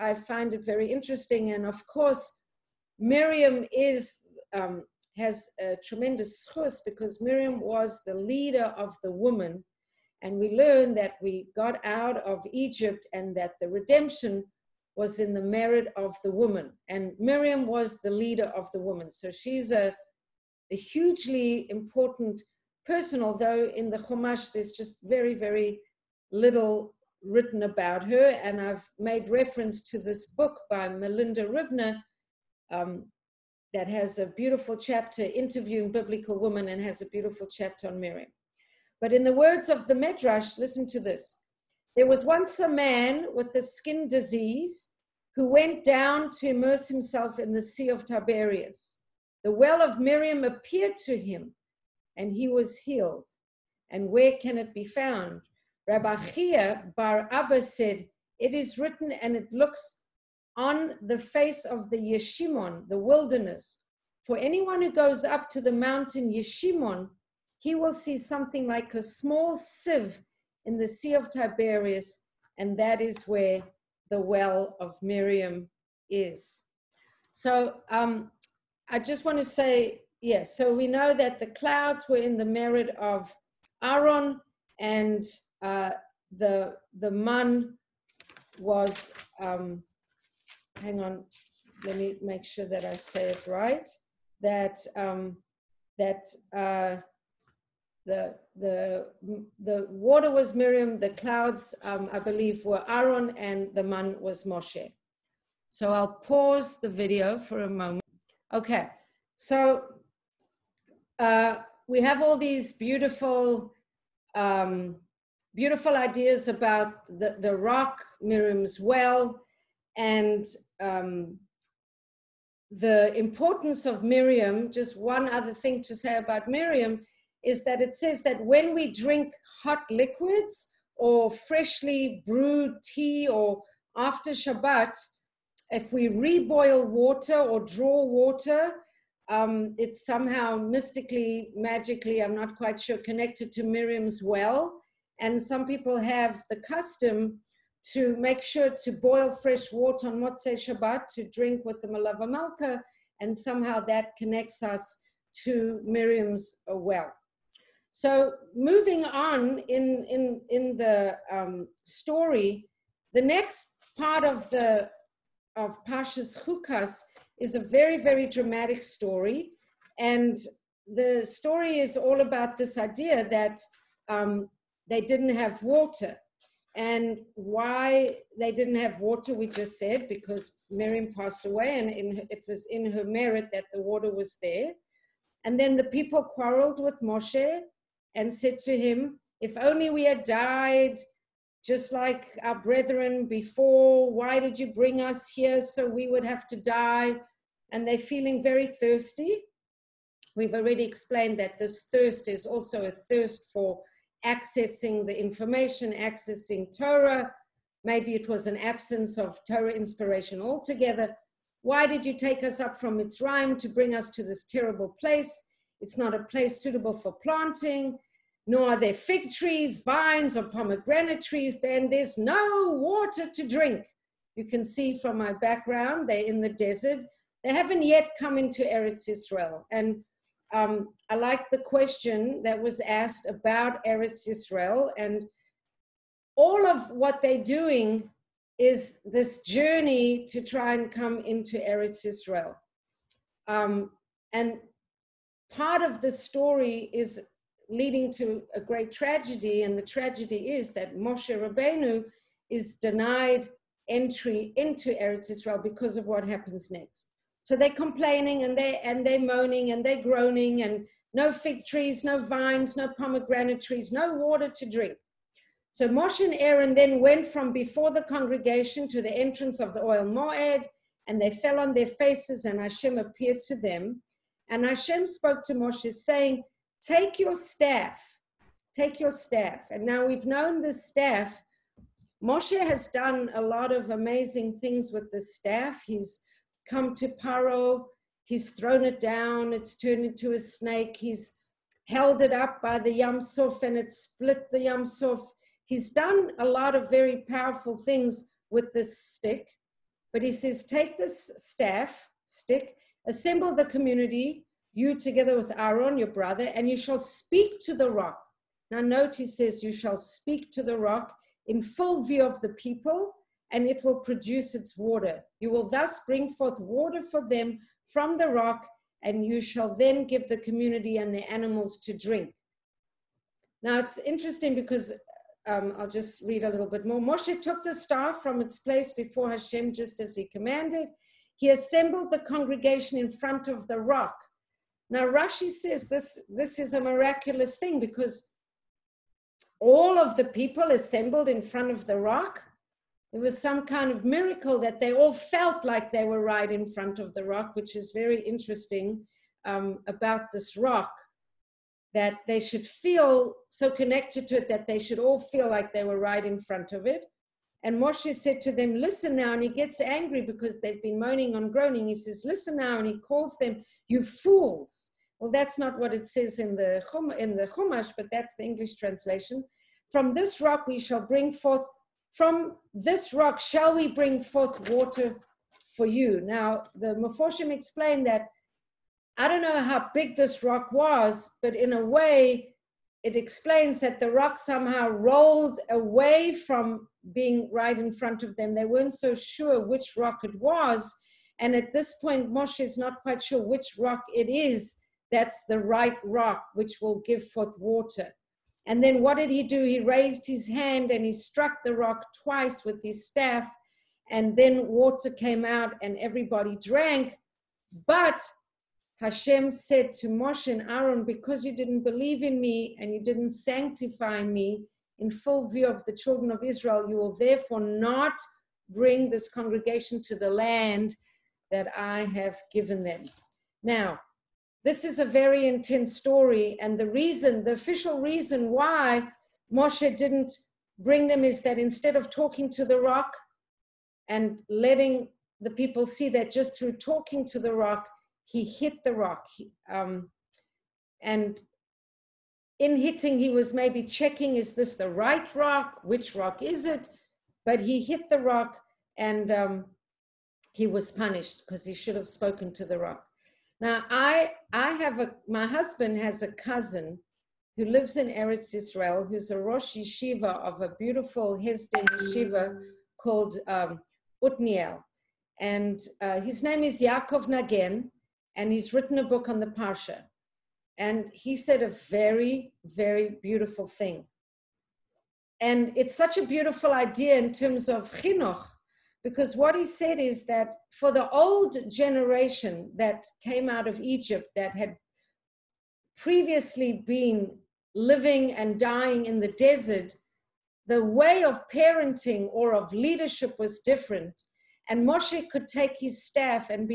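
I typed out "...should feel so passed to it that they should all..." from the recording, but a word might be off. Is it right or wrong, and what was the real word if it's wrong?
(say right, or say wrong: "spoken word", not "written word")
wrong: "connected", not "passed".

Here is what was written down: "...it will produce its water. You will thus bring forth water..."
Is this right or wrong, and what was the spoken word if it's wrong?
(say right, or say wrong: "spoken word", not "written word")
right.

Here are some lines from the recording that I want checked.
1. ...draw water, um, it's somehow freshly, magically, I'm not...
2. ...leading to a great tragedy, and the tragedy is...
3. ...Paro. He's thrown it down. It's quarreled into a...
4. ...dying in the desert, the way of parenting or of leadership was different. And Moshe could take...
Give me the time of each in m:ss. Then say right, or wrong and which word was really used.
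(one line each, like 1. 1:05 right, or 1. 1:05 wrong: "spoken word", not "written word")
1. 2:17 wrong: "mystically", not "freshly"
2. 4:07 right
3. 4:47 wrong: "turned", not "quarreled"
4. 8:08 right.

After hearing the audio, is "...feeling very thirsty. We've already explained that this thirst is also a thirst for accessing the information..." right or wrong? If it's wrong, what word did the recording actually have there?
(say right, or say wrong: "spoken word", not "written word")
right.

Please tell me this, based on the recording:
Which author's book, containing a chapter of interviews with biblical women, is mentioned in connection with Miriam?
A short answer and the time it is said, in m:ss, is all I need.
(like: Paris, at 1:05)
Melinda Ribner, at 0:30.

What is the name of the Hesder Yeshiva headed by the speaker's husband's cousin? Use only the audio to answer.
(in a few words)
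Otniel.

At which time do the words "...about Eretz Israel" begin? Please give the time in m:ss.
3:53.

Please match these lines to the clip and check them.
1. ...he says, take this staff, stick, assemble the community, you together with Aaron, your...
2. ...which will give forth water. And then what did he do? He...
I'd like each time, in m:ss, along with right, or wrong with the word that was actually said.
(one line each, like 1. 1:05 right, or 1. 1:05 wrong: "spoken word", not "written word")
1. 5:00 right
2. 6:36 right.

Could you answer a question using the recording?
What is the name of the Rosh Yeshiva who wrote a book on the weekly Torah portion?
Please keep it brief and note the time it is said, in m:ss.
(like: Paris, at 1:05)
Yaakov Nagen, at 7:46.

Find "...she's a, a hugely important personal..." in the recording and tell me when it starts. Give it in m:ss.
0:19.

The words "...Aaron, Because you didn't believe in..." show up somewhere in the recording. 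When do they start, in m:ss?
6:50.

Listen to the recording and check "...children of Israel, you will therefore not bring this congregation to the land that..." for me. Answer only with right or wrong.
right.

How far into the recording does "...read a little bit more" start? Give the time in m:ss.
5:26.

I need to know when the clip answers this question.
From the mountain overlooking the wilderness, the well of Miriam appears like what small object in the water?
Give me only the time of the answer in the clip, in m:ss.
1:09.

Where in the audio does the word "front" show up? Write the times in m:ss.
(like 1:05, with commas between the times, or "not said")
5:33, 5:41, 5:46, 5:56, 6:27.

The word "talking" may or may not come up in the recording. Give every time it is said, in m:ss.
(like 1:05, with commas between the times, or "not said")
7:12, 7:16.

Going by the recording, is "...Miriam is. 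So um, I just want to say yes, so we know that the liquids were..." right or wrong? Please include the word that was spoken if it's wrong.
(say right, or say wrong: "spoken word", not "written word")
wrong: "clouds", not "liquids".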